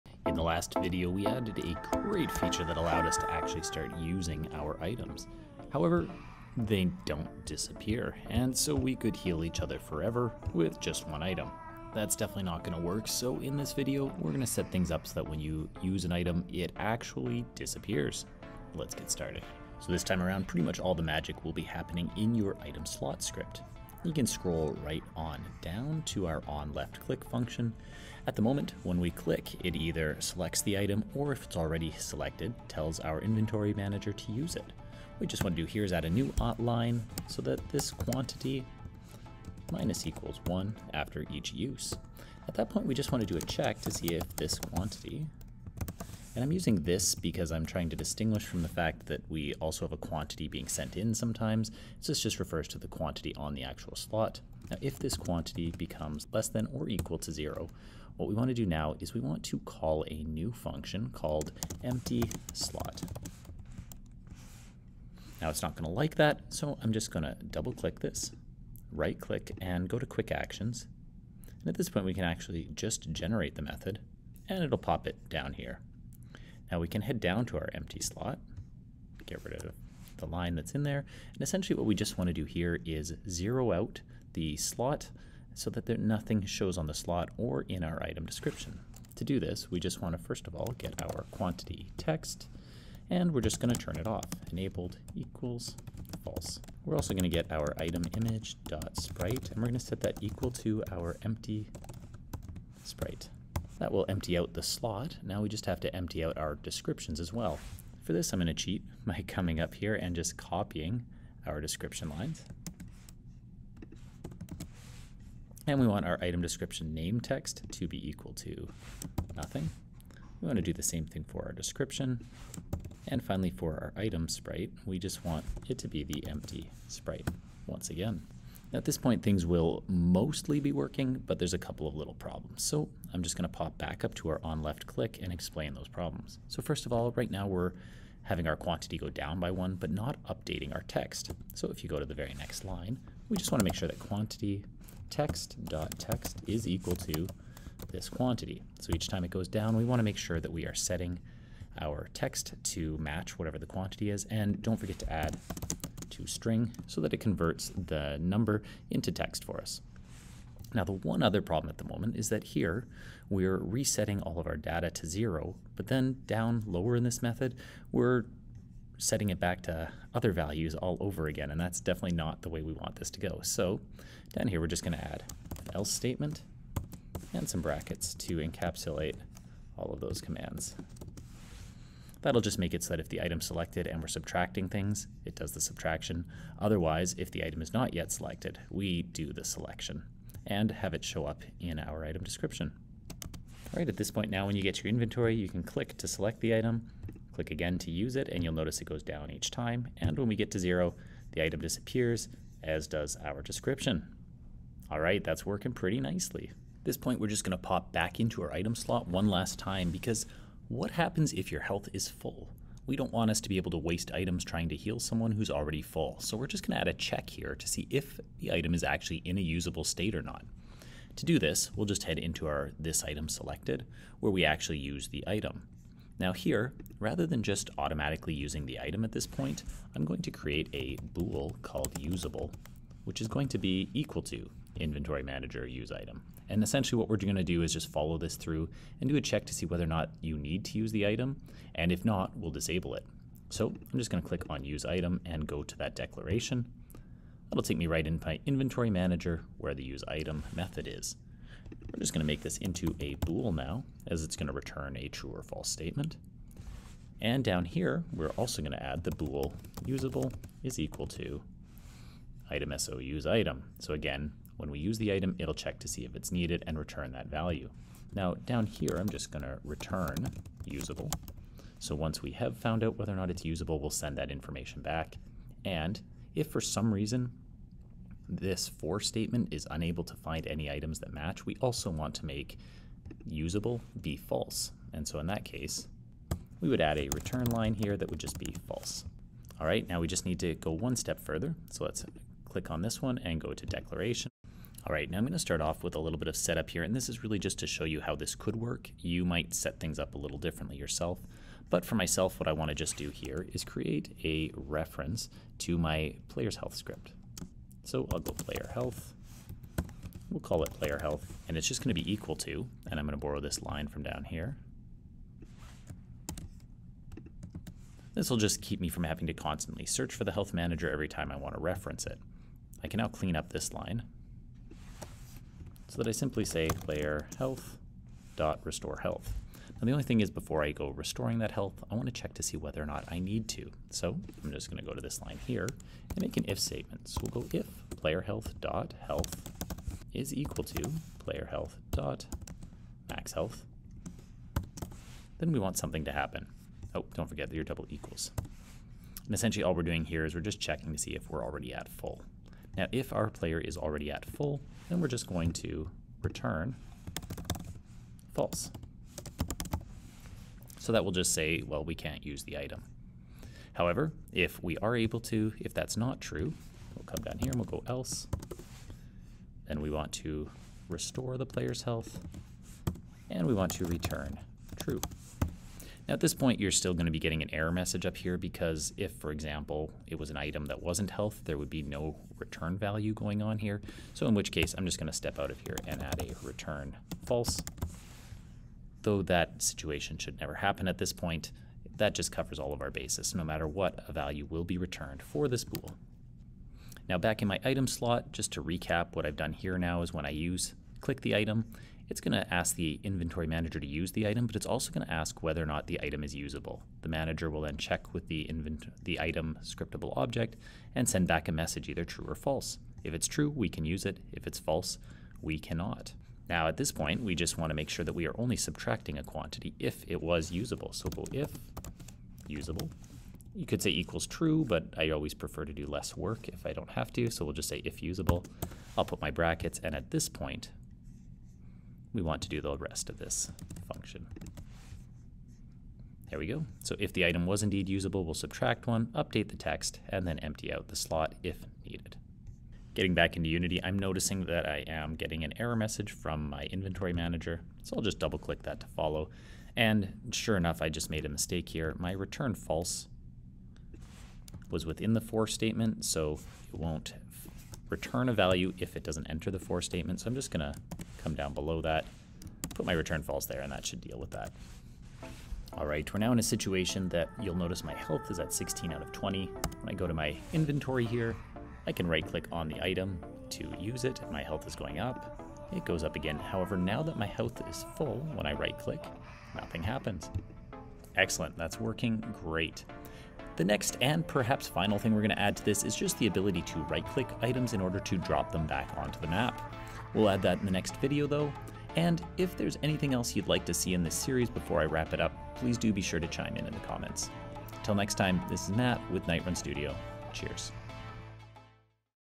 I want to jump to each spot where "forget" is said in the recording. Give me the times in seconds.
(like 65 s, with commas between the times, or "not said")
154 s, 347 s.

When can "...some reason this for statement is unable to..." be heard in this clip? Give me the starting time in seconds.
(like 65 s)
276 s.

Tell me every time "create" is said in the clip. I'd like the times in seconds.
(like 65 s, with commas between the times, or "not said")
230 s, 303 s.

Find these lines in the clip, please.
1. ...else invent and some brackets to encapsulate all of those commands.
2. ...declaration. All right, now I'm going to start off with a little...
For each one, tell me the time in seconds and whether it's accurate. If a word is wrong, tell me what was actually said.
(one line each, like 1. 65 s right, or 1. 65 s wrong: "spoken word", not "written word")
1. 175 s wrong: "statement", not "invent"
2. 293 s right.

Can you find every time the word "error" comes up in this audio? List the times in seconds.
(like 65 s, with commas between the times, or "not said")
377 s, 445 s.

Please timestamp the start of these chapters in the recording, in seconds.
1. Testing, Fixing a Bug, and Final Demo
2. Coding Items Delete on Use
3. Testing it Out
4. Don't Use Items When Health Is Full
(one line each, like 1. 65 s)
1. 442 s
2. 19 s
3. 192 s
4. 206 s.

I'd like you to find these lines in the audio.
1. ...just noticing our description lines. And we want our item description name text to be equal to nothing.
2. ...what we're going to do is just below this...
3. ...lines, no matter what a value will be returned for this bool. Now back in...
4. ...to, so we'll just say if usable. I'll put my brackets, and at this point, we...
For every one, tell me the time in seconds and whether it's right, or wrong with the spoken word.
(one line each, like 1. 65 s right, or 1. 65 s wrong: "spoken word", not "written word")
1. 110 s wrong: "copying", not "noticing"
2. 236 s wrong: "follow", not "below"
3. 392 s wrong: "bases", not "lines"
4. 427 s right.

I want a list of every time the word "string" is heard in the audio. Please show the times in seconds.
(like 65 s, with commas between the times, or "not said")
156 s.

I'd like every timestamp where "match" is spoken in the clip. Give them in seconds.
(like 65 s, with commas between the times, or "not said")
152 s, 281 s.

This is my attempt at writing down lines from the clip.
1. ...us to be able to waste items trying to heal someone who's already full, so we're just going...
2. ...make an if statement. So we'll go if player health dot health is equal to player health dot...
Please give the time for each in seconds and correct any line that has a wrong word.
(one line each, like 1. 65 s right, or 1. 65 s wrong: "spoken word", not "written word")
1. 213 s right
2. 336 s right.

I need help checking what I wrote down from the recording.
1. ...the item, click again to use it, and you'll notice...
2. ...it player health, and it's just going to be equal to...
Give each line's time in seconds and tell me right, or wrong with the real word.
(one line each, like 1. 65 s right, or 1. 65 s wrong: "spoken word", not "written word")
1. 196 s right
2. 310 s right.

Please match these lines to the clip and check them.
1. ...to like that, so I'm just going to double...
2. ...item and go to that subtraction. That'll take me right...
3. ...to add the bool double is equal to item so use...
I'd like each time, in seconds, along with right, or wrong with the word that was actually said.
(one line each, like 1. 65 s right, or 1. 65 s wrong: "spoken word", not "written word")
1. 65 s right
2. 244 s wrong: "declaration", not "subtraction"
3. 258 s wrong: "usable", not "double".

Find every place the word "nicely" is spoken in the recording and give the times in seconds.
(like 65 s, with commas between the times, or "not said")
205 s.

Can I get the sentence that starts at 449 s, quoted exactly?
And sure enough, I just made a mistake here.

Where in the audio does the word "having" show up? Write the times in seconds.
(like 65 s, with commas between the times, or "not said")
138 s, 319 s.